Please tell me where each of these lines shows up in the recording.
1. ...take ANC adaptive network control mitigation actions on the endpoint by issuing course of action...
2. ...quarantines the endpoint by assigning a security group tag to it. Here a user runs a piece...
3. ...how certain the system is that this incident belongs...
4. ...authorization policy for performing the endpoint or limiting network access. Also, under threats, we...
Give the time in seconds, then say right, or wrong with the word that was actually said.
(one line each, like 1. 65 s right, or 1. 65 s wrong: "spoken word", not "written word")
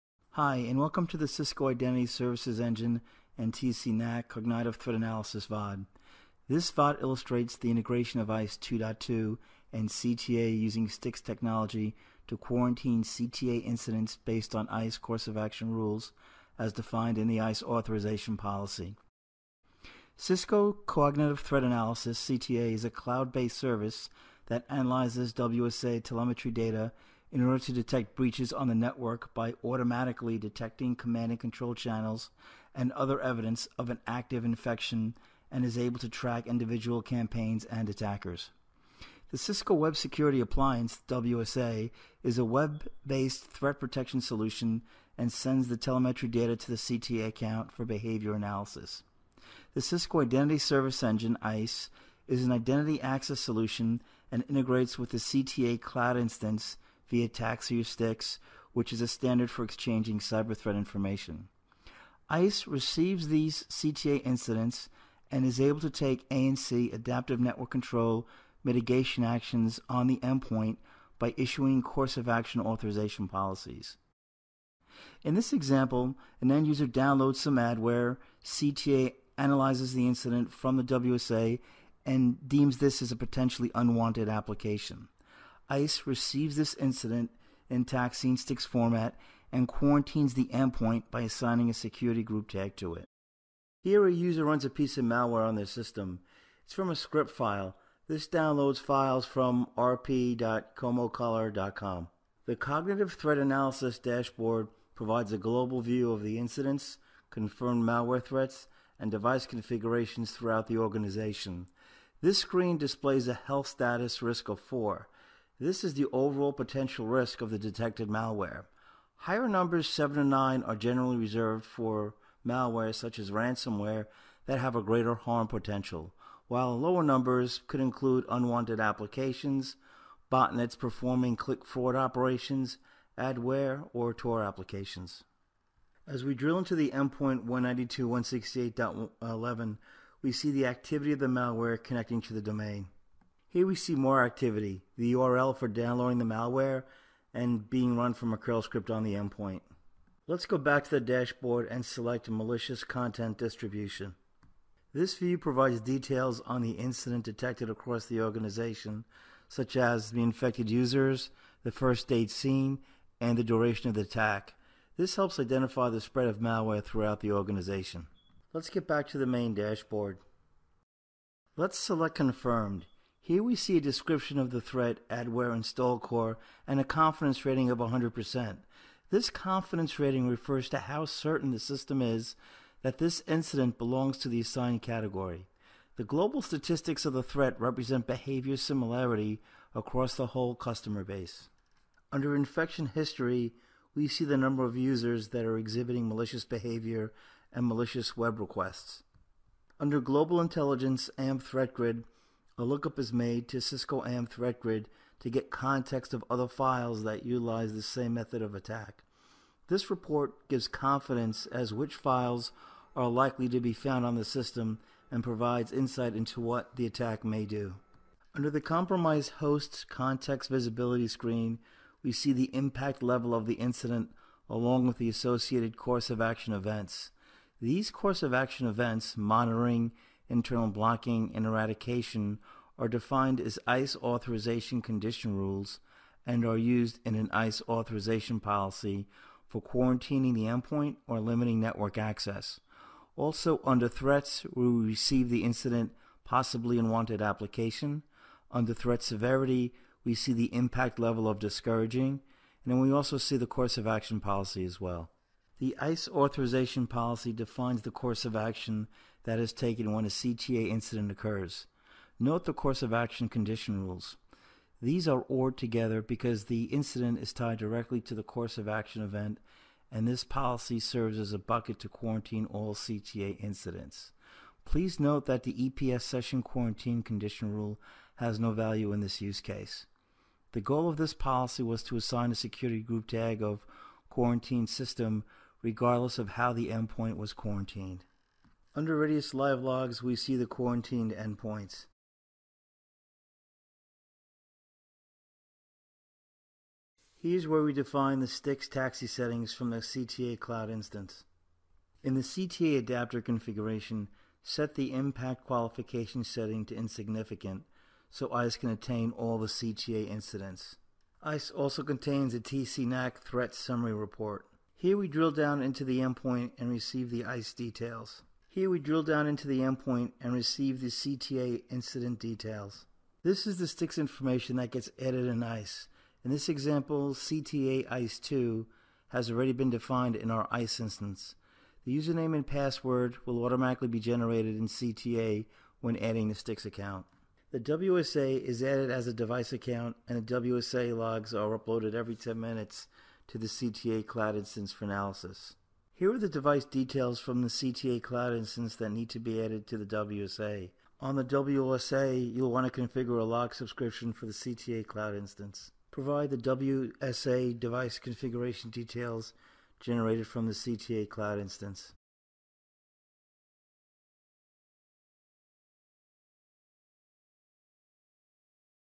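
1. 65 s right
2. 89 s right
3. 180 s right
4. 237 s wrong: "quarantining", not "performing".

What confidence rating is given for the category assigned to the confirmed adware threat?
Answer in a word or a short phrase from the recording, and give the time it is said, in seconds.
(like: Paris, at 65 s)
100%, at 177 s.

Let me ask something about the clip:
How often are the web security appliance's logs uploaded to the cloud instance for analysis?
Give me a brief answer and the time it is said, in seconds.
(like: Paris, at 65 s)
Every 10 minutes, at 341 s.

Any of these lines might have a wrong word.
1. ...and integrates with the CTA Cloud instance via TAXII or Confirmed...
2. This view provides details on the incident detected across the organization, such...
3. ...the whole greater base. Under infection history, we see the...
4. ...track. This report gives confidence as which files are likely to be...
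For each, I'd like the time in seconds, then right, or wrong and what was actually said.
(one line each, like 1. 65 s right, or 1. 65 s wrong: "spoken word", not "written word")
1. 54 s wrong: "STIX", not "Confirmed"
2. 154 s right
3. 190 s wrong: "customer", not "greater"
4. 208 s wrong: "attack", not "track".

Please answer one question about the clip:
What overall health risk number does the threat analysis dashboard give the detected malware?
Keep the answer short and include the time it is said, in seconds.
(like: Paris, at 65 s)
4, at 114 s.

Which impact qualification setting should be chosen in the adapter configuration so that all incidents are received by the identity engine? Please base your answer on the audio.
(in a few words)
Insignificant.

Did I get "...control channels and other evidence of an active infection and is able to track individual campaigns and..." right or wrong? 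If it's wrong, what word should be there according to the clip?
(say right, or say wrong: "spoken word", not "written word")
right.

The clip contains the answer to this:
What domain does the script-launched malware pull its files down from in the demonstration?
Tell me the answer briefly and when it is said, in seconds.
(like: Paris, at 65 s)
rp.comocolor.com, at 99 s.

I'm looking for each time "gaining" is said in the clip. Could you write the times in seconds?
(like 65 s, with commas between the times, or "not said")
not said.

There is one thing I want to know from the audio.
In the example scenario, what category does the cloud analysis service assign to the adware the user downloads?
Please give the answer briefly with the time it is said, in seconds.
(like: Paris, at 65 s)
Potentially unwanted application, at 83 s.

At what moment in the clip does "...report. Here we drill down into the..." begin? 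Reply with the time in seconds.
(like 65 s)
313 s.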